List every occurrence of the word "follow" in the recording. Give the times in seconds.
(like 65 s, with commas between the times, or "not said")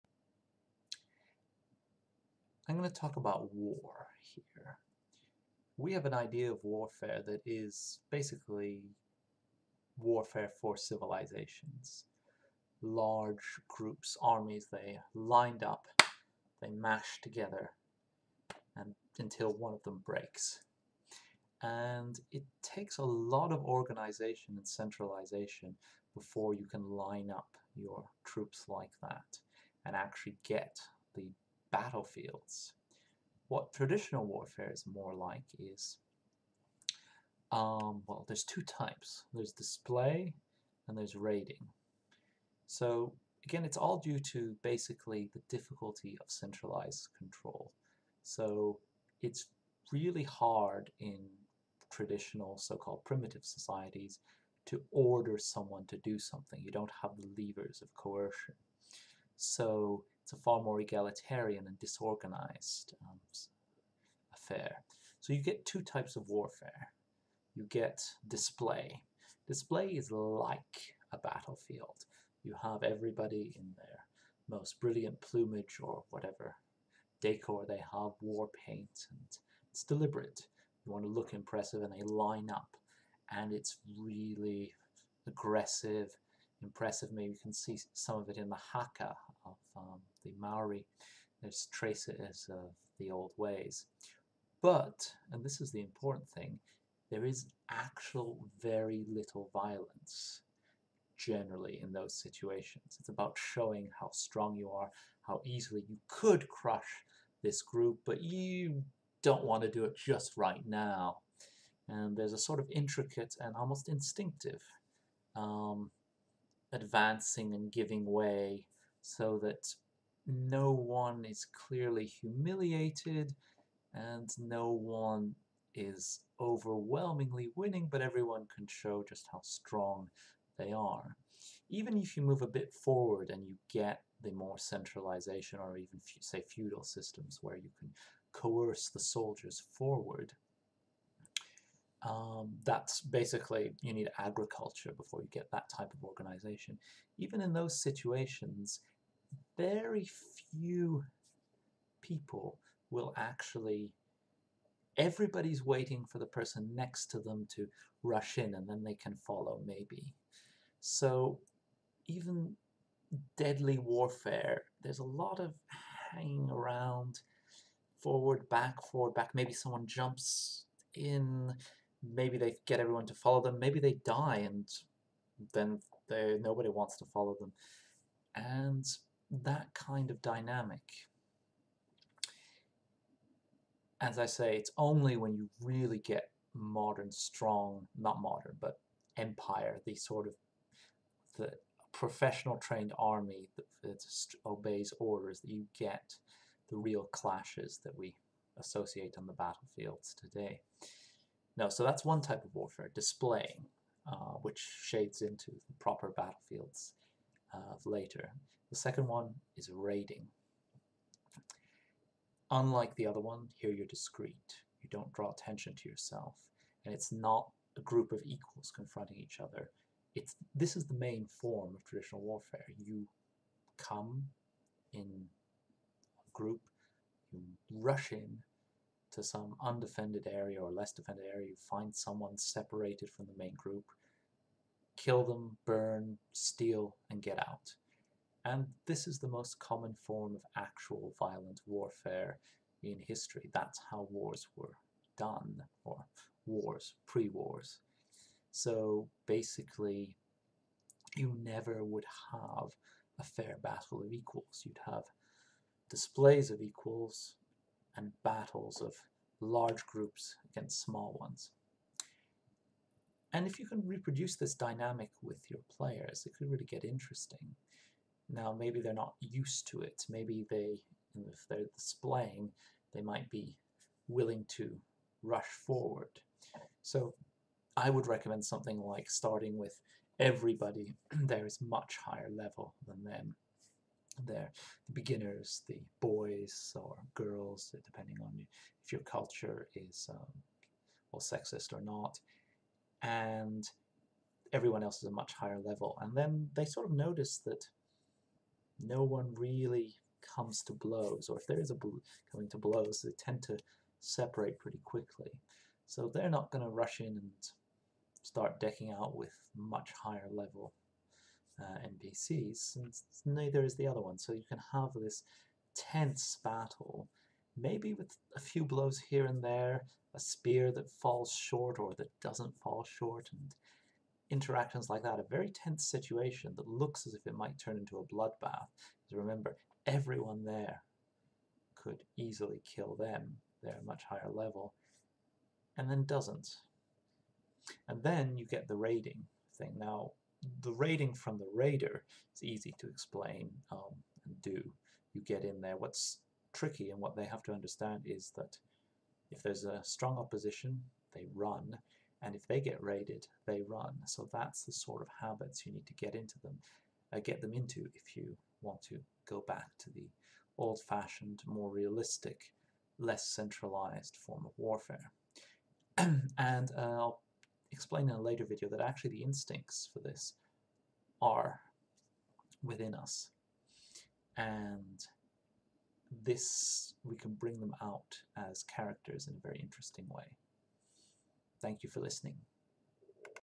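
159 s, 173 s, 177 s.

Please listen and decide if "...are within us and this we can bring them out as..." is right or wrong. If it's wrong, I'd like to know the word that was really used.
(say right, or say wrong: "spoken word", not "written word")
right.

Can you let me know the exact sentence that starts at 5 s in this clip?
We have an idea of warfare that is basically warfare for civilizations.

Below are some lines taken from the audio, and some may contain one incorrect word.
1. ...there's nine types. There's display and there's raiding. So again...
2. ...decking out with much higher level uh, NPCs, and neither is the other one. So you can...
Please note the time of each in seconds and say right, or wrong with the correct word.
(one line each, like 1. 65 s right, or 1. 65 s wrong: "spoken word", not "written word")
1. 38 s wrong: "two", not "nine"
2. 308 s right.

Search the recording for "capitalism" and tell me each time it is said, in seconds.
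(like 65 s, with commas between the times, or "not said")
not said.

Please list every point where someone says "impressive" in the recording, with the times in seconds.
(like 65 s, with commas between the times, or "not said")
81 s, 86 s.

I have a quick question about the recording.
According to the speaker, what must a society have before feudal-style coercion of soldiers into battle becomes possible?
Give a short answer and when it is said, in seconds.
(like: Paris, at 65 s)
agriculture, at 144 s.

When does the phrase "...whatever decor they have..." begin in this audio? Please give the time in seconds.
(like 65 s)
76 s.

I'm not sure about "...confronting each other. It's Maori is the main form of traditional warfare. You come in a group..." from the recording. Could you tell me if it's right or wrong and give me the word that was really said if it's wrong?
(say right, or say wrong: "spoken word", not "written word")
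wrong: "This", not "Maori".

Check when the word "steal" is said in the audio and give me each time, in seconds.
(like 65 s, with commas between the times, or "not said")
236 s.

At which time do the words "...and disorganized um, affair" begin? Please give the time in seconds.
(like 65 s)
61 s.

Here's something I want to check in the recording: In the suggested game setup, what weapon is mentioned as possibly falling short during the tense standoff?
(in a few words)
a spear.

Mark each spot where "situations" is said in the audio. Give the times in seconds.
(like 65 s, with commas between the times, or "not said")
102 s, 147 s, 325 s.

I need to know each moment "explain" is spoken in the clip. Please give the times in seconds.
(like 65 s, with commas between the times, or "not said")
342 s, 367 s.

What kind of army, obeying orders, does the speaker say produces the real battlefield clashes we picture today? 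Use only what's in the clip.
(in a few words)
professional trained army.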